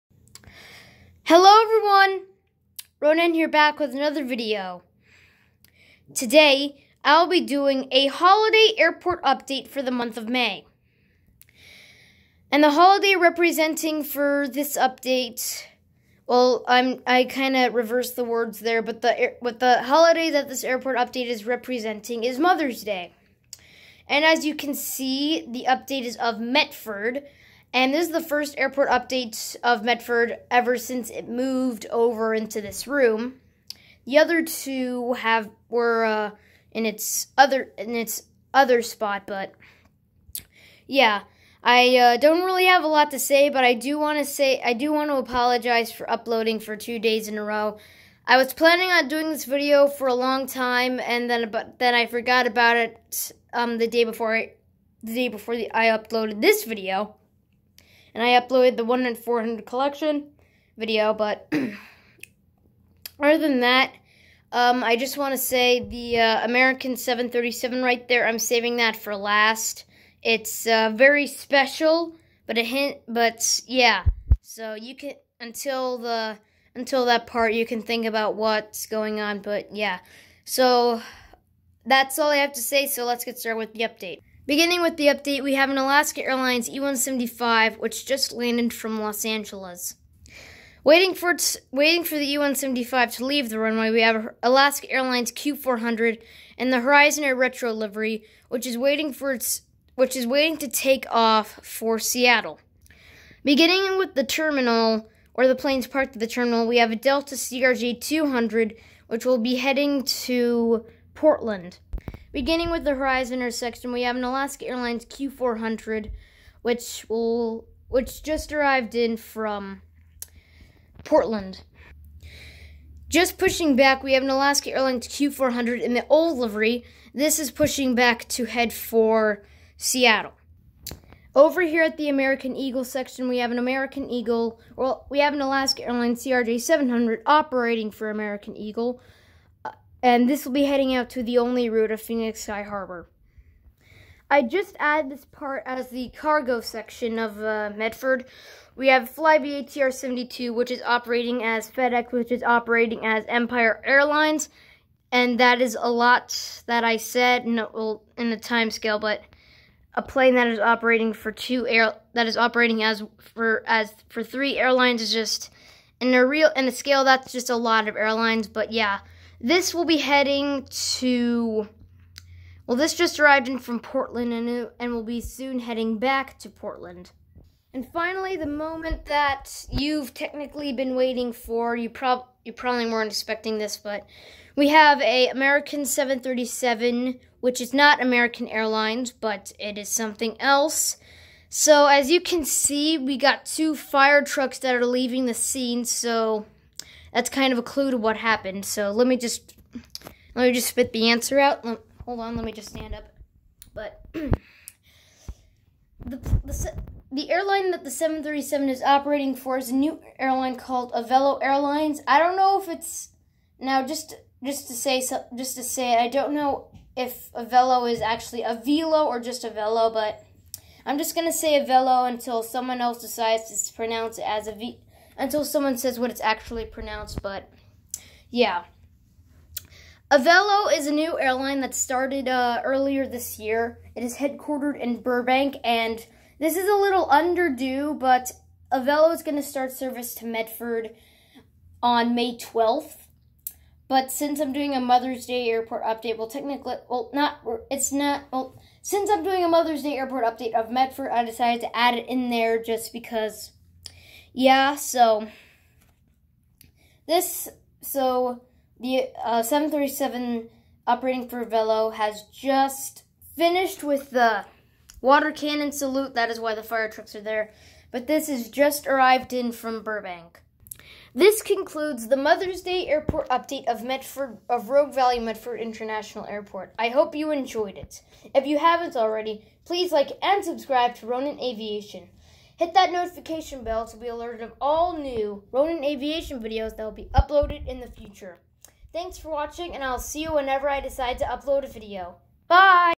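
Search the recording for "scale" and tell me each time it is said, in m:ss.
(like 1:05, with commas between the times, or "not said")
2:38, 2:46.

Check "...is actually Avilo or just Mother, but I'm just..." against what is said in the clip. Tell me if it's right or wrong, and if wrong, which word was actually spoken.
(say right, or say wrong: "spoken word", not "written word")
wrong: "Avello", not "Mother".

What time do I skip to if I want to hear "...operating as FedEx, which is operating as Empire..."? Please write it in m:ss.
2:30.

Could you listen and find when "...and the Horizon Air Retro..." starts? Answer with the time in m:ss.
1:36.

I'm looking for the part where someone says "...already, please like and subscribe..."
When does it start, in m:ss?
4:38.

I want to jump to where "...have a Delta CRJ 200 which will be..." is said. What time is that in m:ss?
1:46.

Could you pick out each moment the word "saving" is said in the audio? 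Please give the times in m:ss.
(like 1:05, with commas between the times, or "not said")
1:08.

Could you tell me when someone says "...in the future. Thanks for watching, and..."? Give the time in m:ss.
4:47.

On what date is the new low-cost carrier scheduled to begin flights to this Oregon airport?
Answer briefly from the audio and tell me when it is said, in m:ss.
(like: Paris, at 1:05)
May 12th, at 4:02.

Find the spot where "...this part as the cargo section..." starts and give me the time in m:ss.
2:25.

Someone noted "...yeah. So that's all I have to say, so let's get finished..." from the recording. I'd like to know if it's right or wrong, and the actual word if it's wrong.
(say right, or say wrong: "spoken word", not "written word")
wrong: "started", not "finished".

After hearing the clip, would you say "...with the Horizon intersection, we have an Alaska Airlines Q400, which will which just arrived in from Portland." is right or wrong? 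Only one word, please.
right.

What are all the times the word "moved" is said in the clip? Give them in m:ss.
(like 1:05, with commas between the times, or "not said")
0:31.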